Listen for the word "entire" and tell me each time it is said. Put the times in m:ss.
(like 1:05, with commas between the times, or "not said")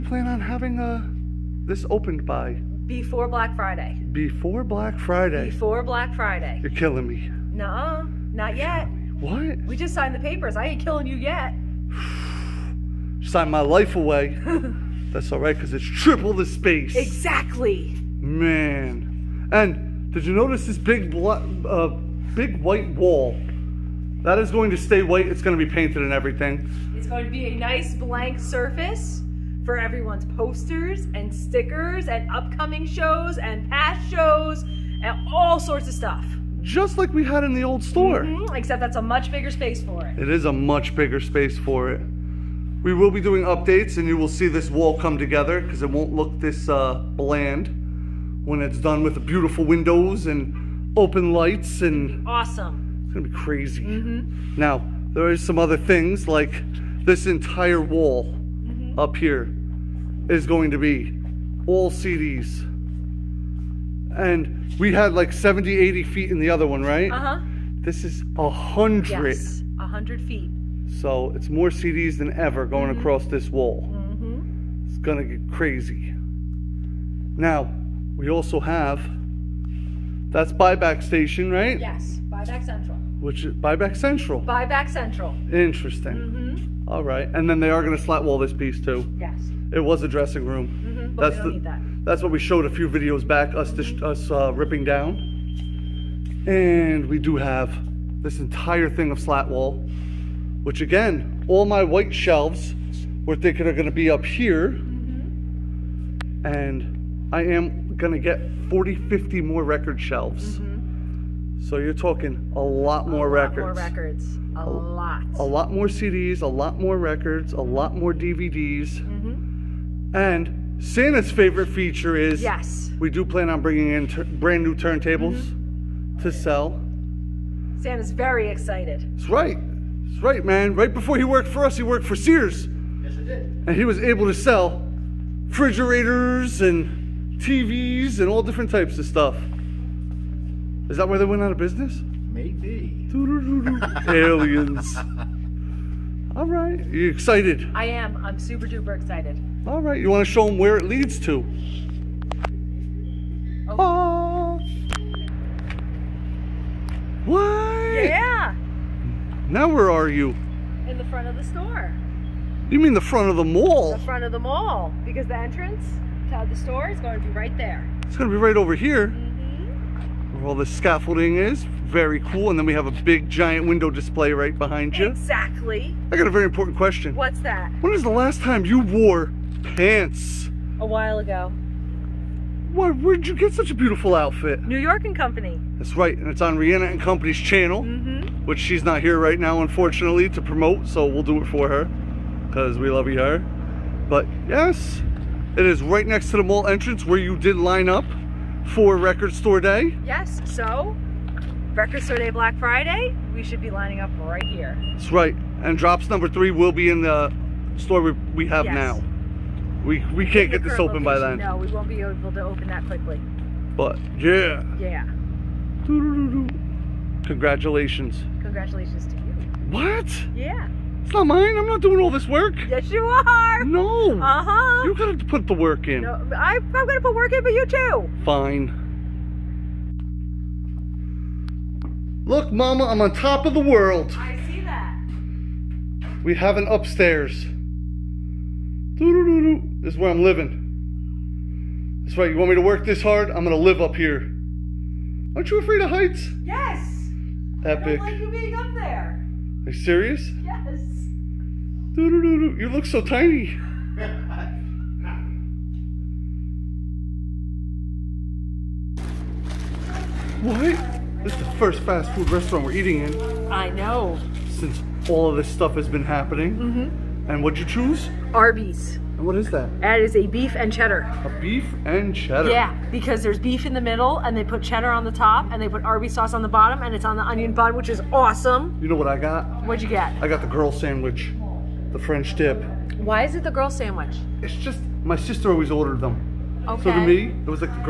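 0:57, 1:38.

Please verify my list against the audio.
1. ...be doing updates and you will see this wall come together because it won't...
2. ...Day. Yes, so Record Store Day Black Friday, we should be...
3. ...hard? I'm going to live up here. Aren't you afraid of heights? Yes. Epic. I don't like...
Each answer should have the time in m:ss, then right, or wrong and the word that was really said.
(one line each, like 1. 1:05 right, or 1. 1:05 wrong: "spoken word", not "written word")
1. 0:43 right
2. 3:19 right
3. 4:03 right.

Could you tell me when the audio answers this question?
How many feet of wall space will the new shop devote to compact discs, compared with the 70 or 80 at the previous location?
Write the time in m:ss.
1:09.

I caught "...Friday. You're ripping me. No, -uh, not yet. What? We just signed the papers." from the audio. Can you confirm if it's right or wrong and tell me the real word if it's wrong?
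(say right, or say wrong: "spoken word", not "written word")
wrong: "killing", not "ripping".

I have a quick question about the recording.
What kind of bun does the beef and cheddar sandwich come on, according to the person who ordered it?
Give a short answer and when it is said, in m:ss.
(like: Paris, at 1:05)
Onion bun, at 4:37.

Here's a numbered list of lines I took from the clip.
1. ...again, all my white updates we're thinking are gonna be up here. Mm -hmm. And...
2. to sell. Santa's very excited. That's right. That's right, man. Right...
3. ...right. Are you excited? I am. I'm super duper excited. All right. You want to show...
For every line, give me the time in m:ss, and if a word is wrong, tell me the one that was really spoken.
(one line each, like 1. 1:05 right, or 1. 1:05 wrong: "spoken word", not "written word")
1. 1:40 wrong: "shelves", not "updates"
2. 2:06 right
3. 2:26 right.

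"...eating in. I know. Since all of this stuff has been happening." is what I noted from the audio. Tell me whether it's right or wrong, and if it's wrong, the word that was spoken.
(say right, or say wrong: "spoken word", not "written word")
right.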